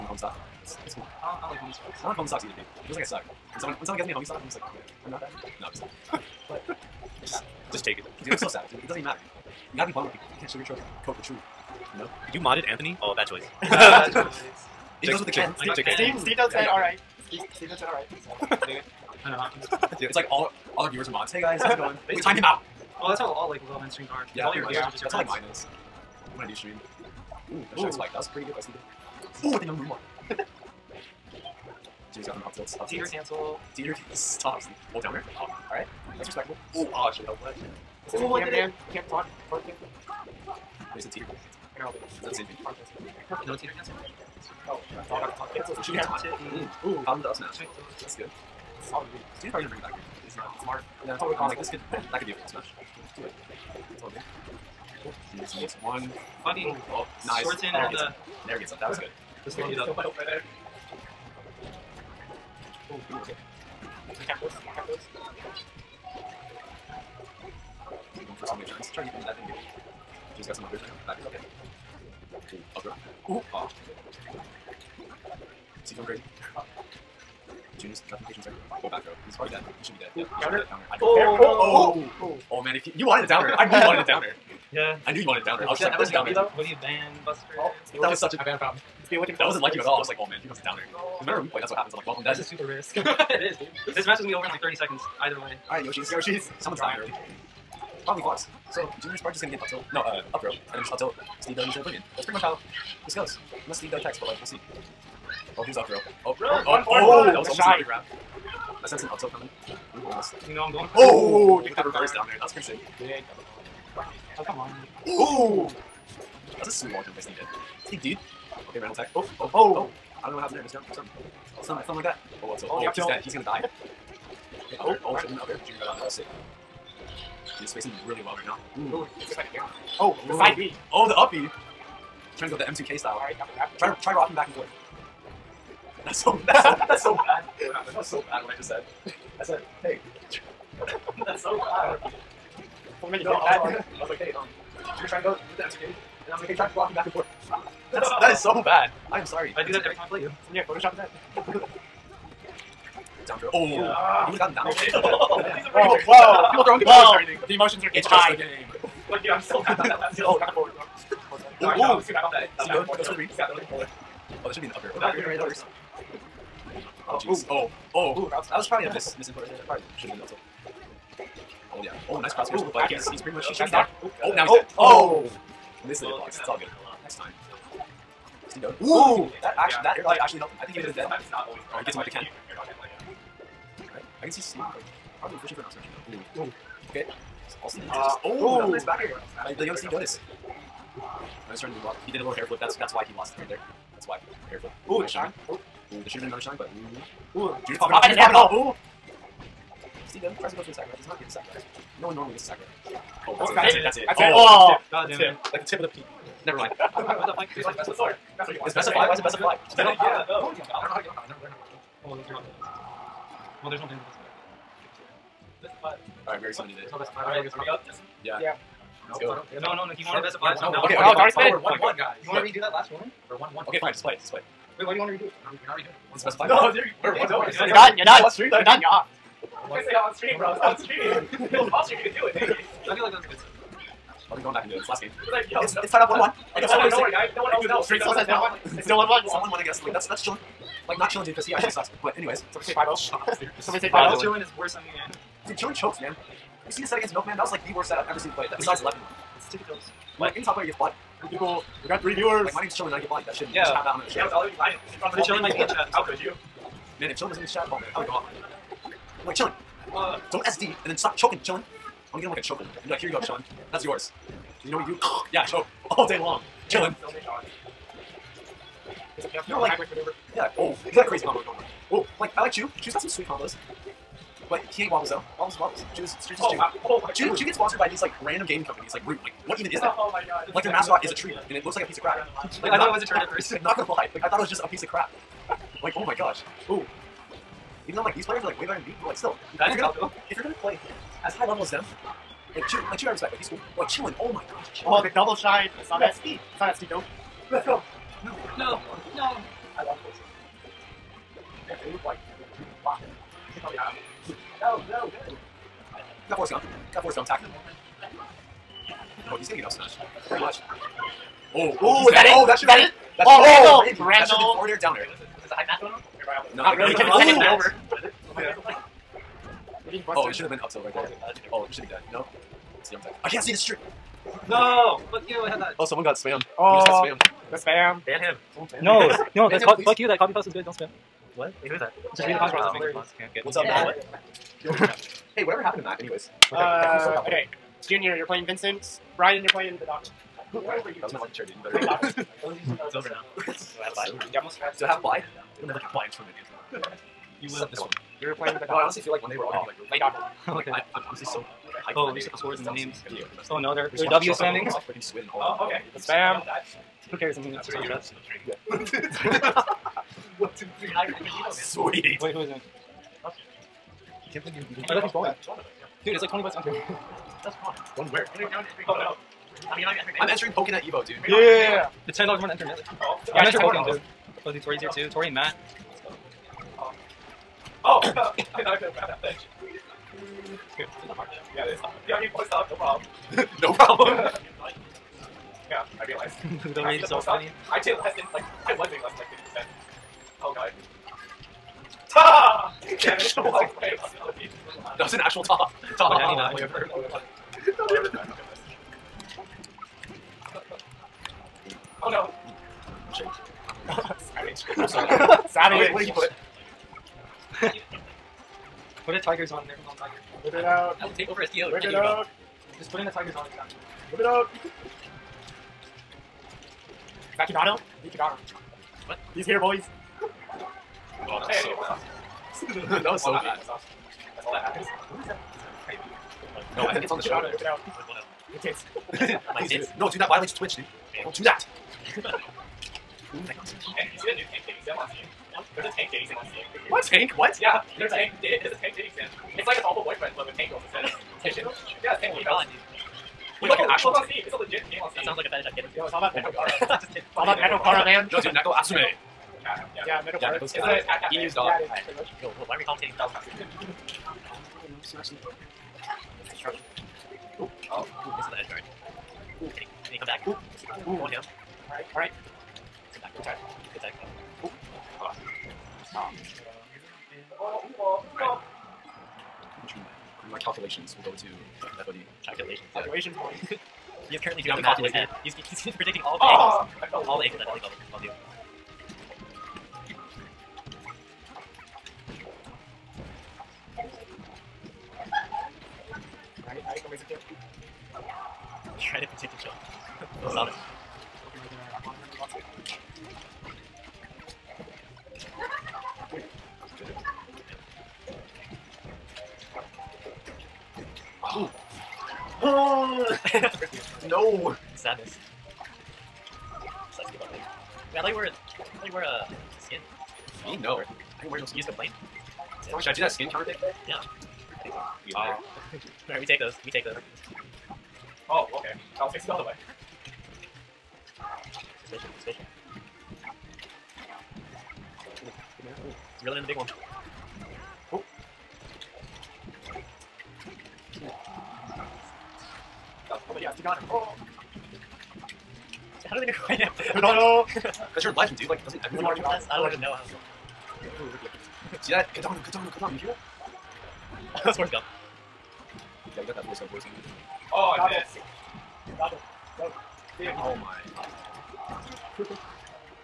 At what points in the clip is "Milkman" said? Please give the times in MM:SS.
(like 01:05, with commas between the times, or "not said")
04:07.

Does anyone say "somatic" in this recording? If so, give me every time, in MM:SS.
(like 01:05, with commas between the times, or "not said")
not said.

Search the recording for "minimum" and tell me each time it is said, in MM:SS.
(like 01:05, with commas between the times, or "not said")
not said.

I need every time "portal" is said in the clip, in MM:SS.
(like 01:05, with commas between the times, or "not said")
not said.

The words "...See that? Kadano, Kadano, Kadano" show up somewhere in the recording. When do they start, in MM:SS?
09:02.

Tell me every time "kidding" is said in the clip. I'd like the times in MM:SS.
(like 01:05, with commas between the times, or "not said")
07:27.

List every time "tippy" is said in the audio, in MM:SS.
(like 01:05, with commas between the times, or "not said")
04:09.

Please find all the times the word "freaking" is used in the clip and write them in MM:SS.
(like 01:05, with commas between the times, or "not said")
05:54.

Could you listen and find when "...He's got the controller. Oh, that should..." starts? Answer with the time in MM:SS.
02:43.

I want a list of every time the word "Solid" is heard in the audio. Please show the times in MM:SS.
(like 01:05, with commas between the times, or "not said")
00:48, 08:10.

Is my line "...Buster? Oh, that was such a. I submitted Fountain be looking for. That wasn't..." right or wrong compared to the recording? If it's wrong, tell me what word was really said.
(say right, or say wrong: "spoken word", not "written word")
wrong: "banned", not "submitted".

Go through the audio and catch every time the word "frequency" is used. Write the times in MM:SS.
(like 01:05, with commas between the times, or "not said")
not said.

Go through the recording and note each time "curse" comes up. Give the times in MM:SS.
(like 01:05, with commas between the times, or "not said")
not said.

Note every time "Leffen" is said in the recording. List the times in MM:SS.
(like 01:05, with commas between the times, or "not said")
04:08.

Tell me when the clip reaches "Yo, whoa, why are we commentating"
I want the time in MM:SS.
07:32.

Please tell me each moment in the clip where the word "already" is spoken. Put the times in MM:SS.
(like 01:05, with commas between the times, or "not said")
03:36, 03:41.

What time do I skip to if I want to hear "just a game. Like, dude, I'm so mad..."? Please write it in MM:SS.
02:38.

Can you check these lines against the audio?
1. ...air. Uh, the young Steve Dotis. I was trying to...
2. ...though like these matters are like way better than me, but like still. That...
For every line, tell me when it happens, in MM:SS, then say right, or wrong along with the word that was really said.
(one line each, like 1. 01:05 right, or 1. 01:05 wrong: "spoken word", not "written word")
1. 03:09 right
2. 04:47 wrong: "players", not "matters".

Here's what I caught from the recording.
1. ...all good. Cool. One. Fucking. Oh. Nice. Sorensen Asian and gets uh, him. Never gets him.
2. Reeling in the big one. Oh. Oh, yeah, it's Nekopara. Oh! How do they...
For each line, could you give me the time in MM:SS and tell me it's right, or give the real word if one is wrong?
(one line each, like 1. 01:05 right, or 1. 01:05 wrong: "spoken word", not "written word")
1. 00:54 wrong: "Never", not "Asian"
2. 08:46 wrong: "Tagano", not "Nekopara".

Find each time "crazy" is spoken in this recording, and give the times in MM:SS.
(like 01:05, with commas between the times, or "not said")
01:16, 04:31.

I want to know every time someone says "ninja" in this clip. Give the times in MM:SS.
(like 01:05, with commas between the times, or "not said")
not said.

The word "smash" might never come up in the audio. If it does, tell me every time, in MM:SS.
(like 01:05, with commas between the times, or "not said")
00:47, 00:52, 03:05, 05:09.